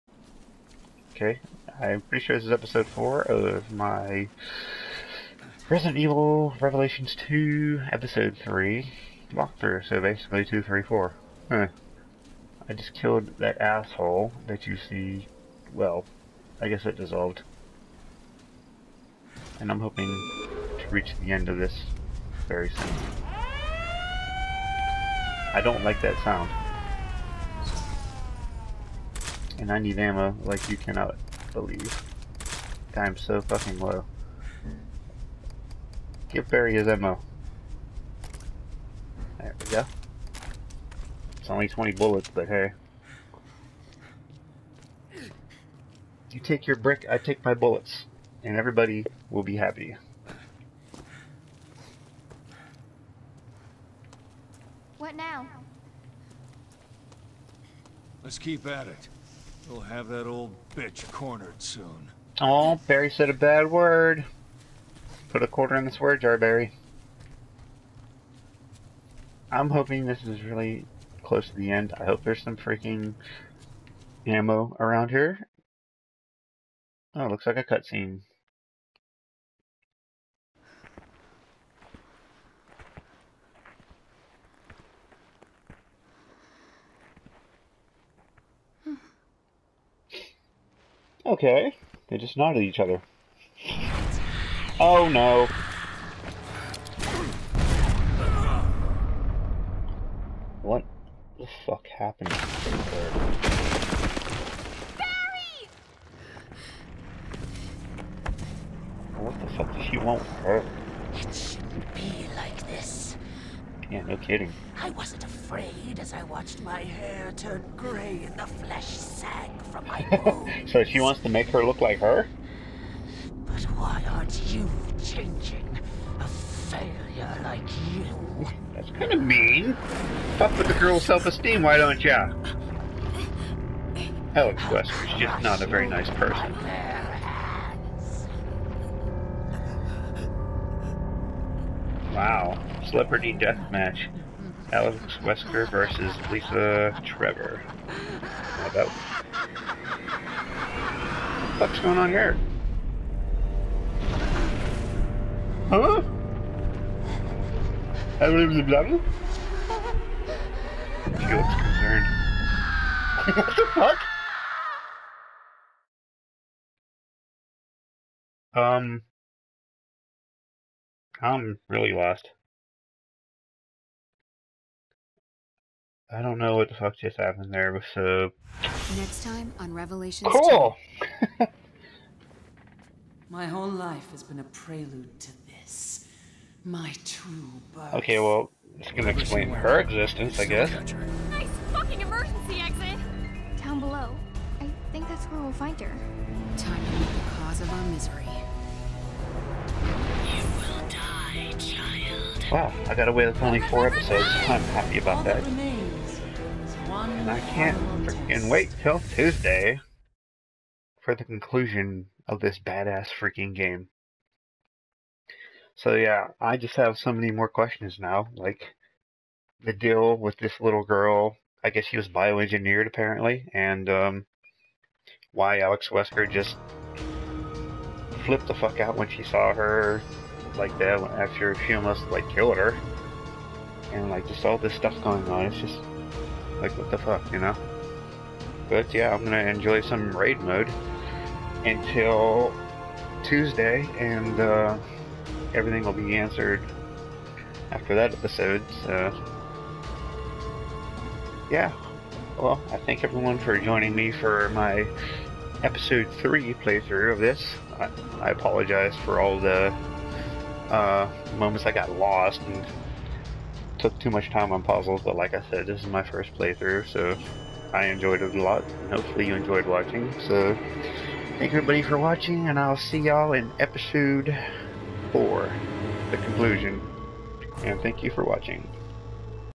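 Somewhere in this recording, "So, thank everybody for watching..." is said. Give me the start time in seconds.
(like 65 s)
270 s.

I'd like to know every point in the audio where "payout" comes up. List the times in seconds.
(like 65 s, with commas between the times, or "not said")
not said.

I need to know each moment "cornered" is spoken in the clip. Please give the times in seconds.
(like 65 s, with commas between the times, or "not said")
61 s.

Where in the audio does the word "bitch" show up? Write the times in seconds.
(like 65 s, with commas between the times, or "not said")
60 s.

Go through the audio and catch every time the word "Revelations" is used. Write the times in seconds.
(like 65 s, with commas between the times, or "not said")
6 s, 179 s.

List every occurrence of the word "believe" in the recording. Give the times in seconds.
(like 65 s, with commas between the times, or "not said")
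31 s, 158 s.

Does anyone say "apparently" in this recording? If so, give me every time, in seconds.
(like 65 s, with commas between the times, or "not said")
222 s.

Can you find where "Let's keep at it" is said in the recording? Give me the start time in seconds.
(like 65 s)
58 s.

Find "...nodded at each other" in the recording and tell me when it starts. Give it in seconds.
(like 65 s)
92 s.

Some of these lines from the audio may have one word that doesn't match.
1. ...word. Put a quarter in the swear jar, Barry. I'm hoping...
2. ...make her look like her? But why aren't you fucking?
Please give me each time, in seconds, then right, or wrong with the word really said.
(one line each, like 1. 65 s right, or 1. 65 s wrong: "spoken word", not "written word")
1. 63 s right
2. 121 s wrong: "changing", not "fucking".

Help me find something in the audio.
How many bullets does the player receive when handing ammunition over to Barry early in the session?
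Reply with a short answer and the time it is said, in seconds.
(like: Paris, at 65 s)
20, at 41 s.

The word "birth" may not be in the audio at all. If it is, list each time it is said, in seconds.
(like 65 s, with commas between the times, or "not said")
187 s.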